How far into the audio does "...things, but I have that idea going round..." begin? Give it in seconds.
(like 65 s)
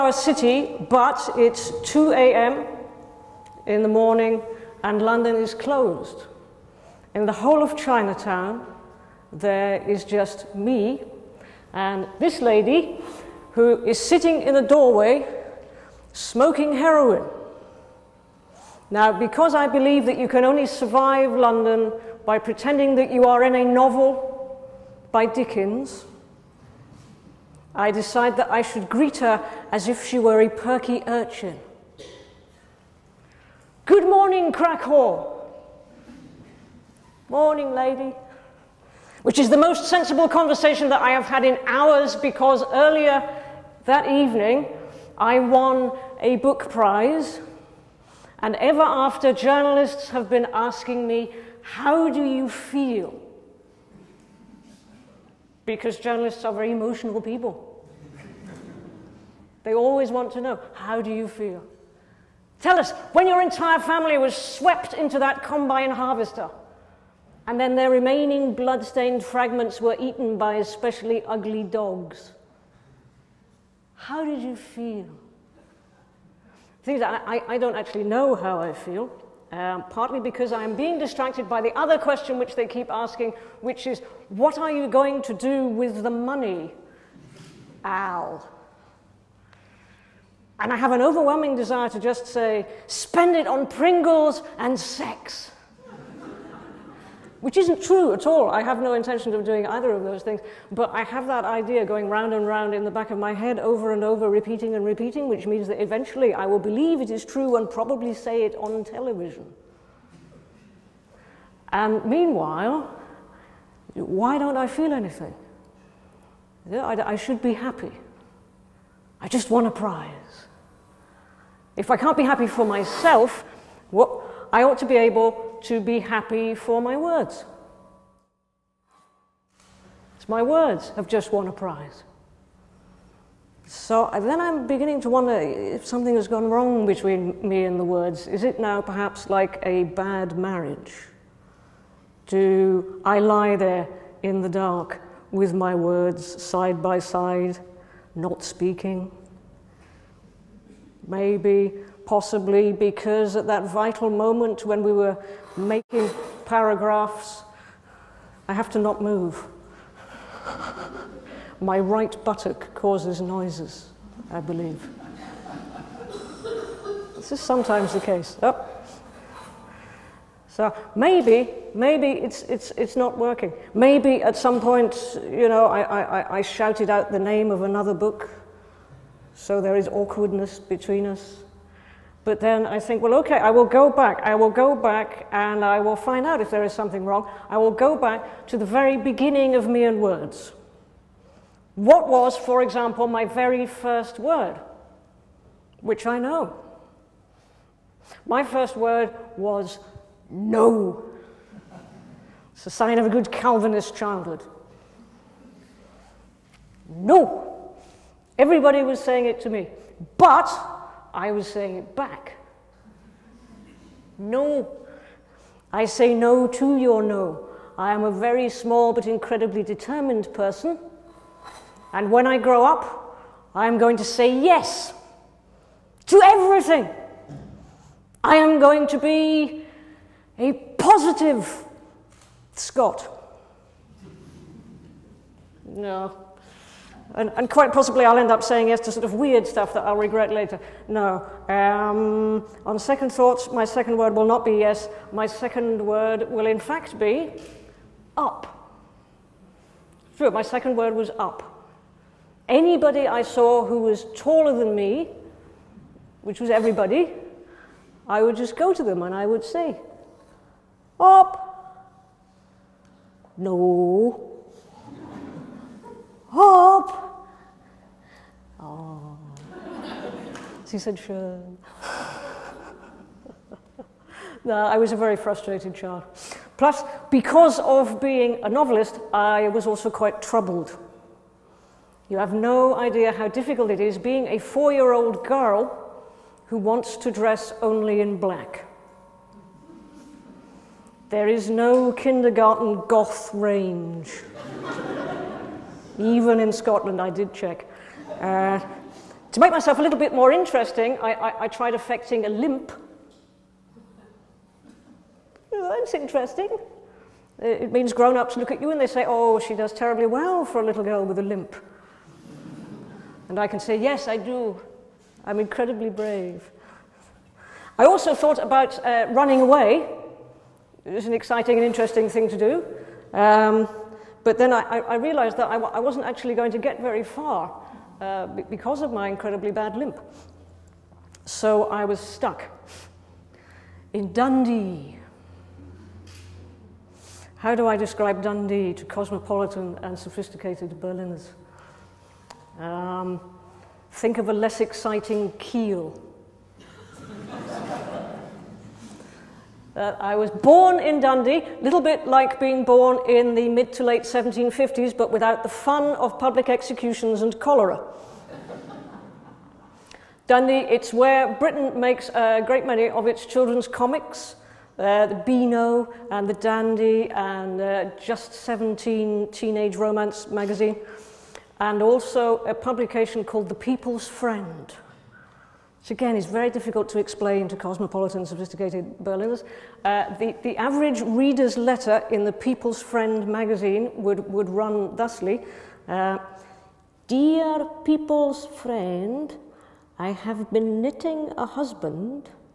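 100 s.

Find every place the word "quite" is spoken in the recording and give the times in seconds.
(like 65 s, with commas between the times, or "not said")
237 s, 279 s.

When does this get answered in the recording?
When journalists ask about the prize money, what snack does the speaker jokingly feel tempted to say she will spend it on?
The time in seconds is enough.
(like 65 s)
93 s.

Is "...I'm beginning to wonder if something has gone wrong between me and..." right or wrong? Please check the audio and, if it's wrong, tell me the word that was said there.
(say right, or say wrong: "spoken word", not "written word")
right.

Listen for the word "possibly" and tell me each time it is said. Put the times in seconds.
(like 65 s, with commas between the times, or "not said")
152 s, 237 s.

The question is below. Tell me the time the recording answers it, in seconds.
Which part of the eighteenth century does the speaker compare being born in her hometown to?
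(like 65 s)
353 s.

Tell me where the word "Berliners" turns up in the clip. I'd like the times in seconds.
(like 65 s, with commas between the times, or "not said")
340 s, 379 s.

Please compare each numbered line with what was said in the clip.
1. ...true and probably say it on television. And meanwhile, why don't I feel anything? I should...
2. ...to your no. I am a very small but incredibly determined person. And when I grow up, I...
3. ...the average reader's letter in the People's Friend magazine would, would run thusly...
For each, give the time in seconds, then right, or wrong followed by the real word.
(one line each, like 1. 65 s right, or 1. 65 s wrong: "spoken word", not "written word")
1. 107 s right
2. 216 s right
3. 380 s right.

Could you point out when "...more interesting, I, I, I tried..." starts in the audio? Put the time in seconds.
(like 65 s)
300 s.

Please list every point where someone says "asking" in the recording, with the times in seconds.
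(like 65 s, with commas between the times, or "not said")
50 s, 82 s.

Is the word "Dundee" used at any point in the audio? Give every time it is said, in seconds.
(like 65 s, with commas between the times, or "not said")
334 s, 338 s, 351 s, 360 s.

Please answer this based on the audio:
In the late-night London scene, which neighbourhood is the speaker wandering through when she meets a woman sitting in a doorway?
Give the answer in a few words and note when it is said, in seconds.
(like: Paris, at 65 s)
Chinatown, at 7 s.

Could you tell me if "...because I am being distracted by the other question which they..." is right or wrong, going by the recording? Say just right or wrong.
right.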